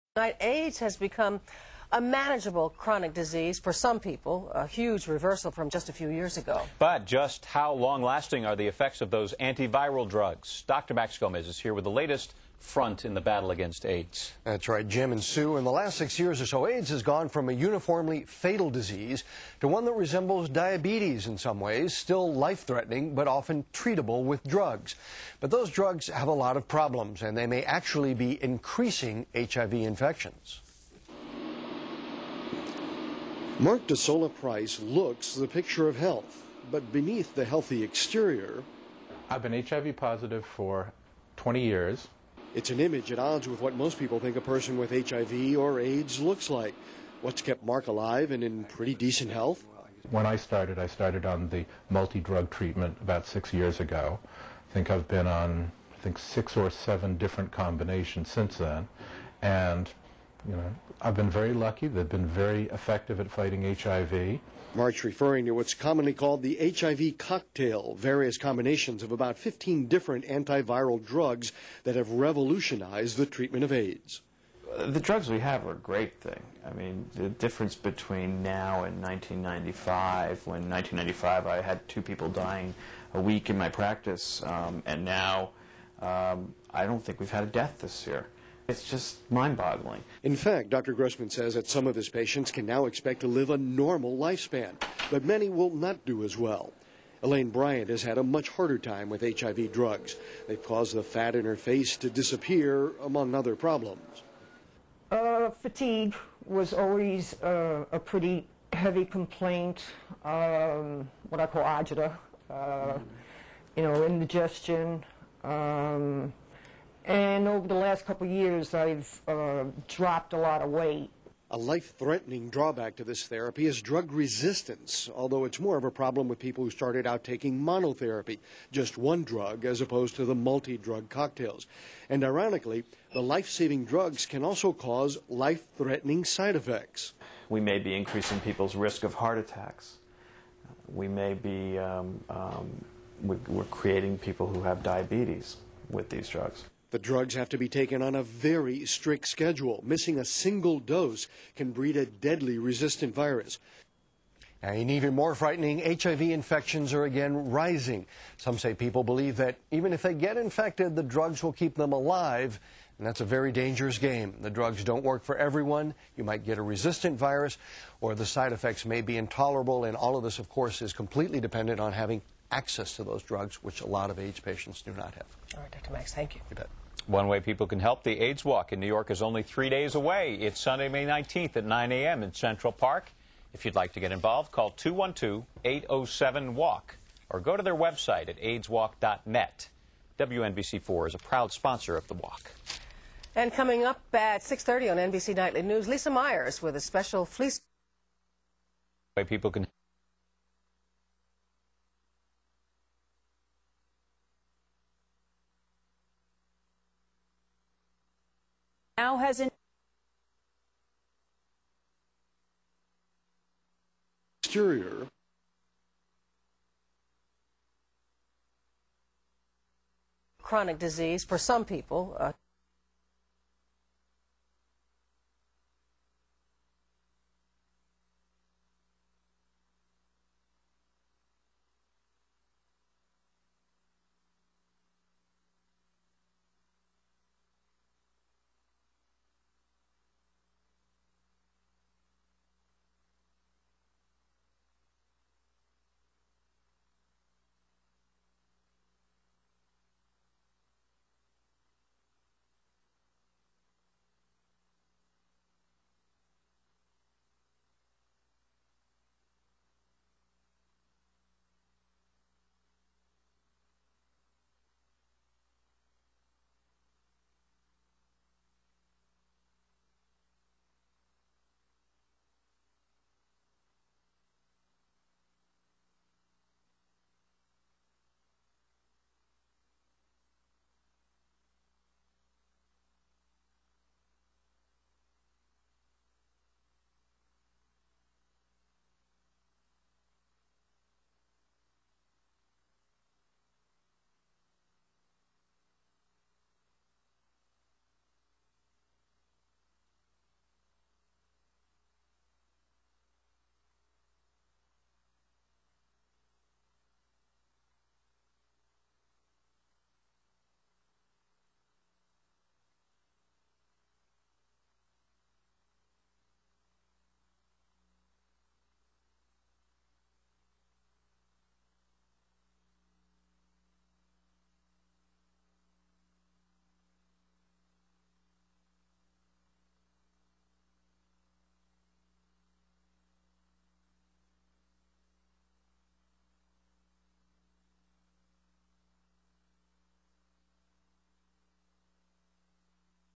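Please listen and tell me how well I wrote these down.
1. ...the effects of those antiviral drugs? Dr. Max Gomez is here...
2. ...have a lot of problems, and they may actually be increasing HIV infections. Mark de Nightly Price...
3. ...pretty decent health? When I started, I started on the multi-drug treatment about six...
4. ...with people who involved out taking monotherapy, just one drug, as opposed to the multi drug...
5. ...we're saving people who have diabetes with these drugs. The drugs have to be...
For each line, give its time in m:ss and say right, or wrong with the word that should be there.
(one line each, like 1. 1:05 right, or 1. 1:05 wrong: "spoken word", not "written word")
1. 0:08 right
2. 0:26 wrong: "Solla", not "Nightly"
3. 0:48 right
4. 2:06 wrong: "started", not "involved"
5. 2:23 wrong: "creating", not "saving".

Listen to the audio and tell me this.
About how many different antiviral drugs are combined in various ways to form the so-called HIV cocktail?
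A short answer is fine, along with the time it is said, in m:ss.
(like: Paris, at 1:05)
15, at 1:09.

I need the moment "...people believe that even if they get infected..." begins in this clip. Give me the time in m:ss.
2:38.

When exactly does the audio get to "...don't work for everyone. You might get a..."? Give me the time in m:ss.
2:44.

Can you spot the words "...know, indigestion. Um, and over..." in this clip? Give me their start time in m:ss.
1:53.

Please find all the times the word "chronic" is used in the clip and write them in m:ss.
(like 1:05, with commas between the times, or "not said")
0:02, 3:40.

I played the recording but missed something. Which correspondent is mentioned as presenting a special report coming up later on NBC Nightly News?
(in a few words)
Lisa Myers.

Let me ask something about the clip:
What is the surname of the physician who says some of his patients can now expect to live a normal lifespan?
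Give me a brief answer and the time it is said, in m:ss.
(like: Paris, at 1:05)
Grossman, at 1:30.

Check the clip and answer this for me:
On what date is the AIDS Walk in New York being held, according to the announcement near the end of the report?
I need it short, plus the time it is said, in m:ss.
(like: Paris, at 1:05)
May 19th, at 3:00.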